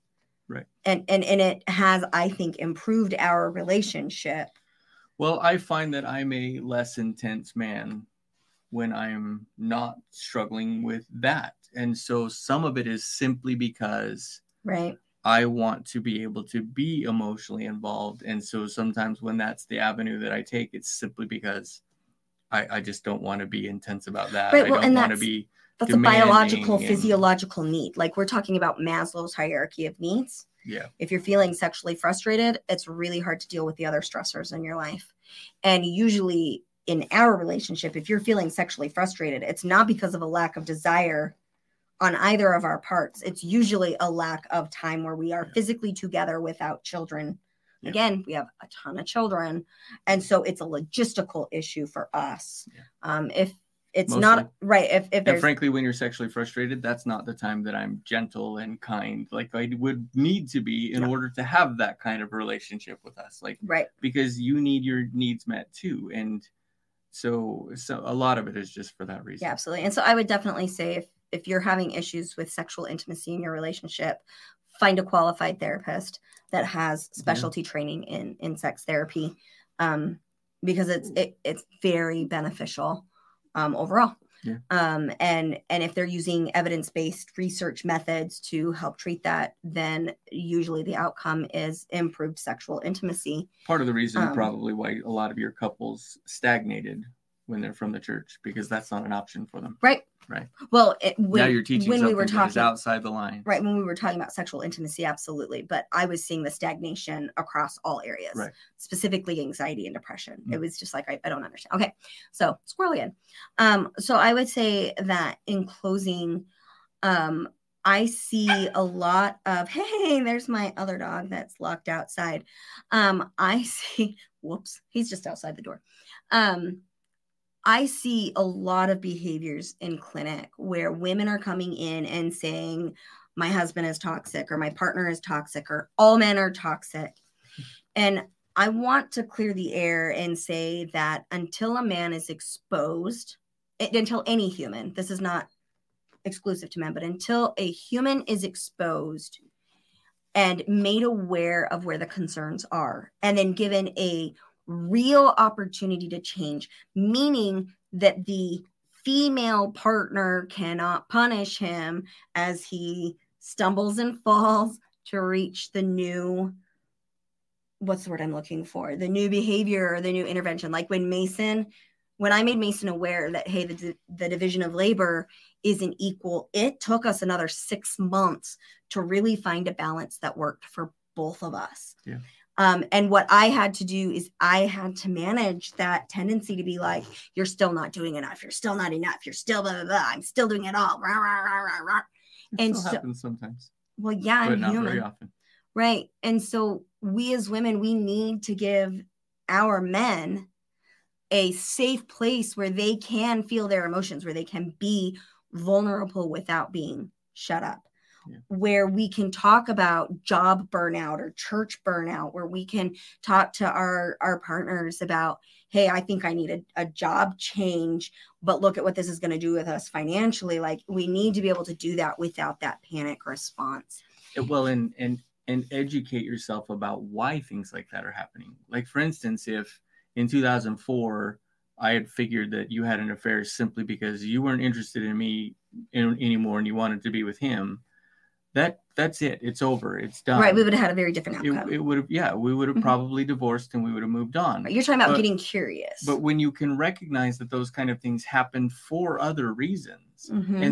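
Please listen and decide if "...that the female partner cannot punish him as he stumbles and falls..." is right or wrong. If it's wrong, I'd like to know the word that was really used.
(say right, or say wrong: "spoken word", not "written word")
right.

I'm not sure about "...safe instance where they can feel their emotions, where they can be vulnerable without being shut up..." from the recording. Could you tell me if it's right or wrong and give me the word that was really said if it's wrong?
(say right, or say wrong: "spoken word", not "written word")
wrong: "place", not "instance".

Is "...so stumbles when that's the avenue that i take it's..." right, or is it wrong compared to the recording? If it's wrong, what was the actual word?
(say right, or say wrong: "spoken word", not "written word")
wrong: "sometimes", not "stumbles".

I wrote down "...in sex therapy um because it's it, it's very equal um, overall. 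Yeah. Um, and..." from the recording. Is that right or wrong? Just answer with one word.
wrong.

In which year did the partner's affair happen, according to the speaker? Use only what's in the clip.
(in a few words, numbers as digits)
2004.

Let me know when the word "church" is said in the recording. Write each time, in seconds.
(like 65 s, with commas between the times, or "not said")
97 s, 211 s.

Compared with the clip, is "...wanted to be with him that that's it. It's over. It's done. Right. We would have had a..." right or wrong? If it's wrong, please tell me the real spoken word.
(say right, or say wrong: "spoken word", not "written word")
right.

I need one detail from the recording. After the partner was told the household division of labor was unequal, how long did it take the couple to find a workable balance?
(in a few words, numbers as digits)
6 months.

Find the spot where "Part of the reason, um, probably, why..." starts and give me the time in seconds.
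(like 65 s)
93 s.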